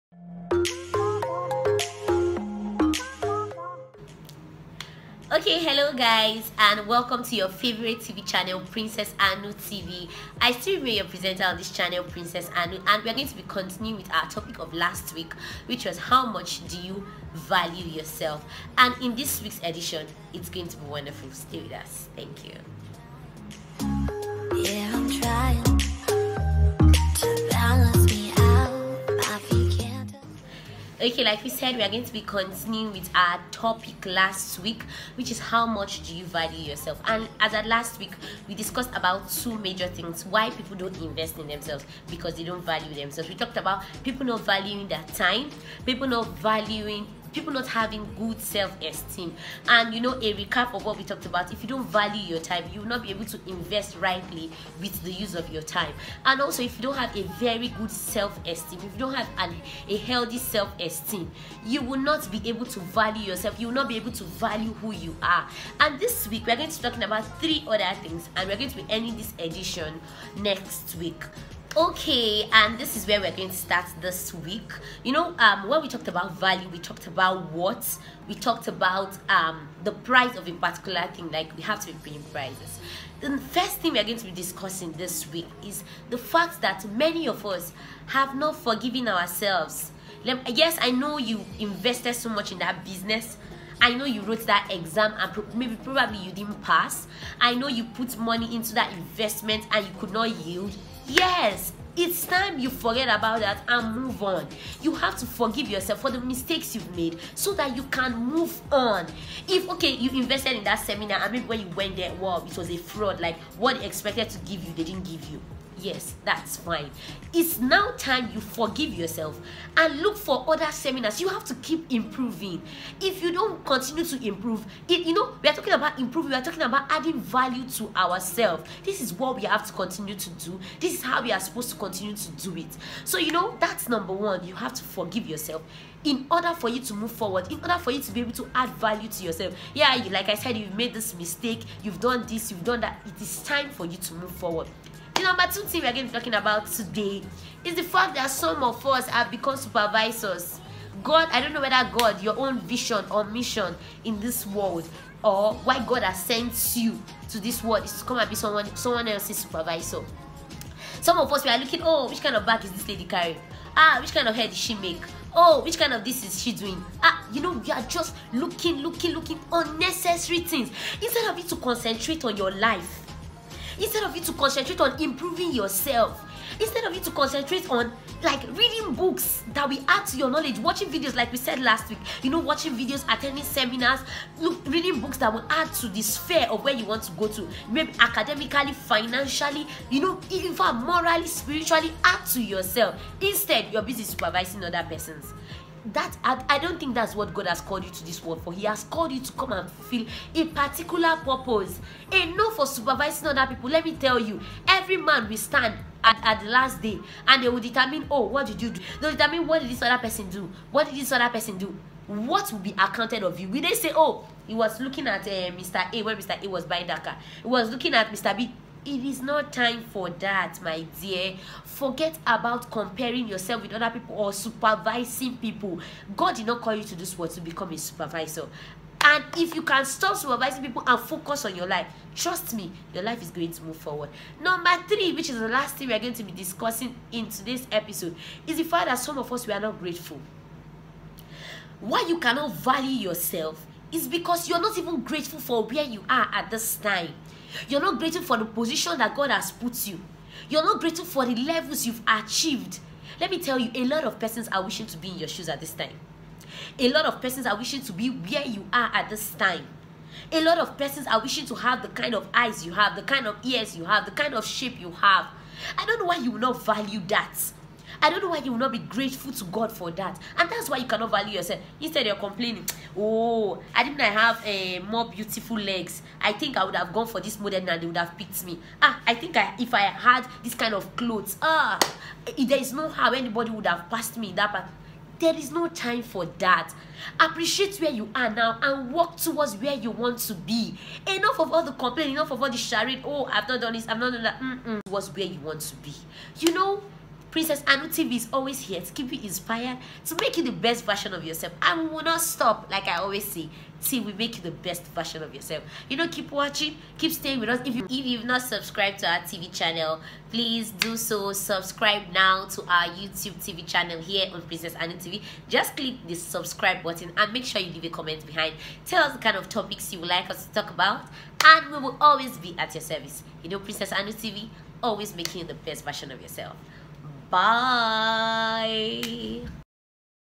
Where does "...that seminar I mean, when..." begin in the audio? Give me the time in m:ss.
1:50.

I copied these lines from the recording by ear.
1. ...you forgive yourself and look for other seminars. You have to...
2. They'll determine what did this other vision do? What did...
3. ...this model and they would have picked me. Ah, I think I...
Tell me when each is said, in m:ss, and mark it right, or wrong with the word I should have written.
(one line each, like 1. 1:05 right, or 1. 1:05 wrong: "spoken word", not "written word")
1. 1:58 right
2. 3:29 wrong: "person", not "vision"
3. 4:37 right.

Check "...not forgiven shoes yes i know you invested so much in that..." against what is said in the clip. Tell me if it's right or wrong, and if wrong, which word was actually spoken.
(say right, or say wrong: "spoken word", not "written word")
wrong: "ourselves", not "shoes".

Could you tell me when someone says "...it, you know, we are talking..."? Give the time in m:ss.
2:04.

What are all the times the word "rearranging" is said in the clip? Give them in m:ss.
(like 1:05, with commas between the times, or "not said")
not said.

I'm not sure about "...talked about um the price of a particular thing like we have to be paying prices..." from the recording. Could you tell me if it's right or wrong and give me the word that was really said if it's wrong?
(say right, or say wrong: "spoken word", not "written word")
right.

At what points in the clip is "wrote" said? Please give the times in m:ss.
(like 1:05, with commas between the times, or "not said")
1:34.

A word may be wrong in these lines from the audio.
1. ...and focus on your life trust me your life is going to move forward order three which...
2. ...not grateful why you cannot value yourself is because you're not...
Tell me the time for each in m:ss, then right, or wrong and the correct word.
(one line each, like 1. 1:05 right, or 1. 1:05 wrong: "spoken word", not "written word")
1. 3:50 wrong: "number", not "order"
2. 3:59 right.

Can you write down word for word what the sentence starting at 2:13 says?
So, you know, that's number one.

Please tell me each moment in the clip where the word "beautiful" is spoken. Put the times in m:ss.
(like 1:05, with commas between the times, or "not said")
4:35.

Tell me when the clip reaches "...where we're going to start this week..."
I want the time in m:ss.
1:13.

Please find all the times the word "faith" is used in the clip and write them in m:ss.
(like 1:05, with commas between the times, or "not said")
not said.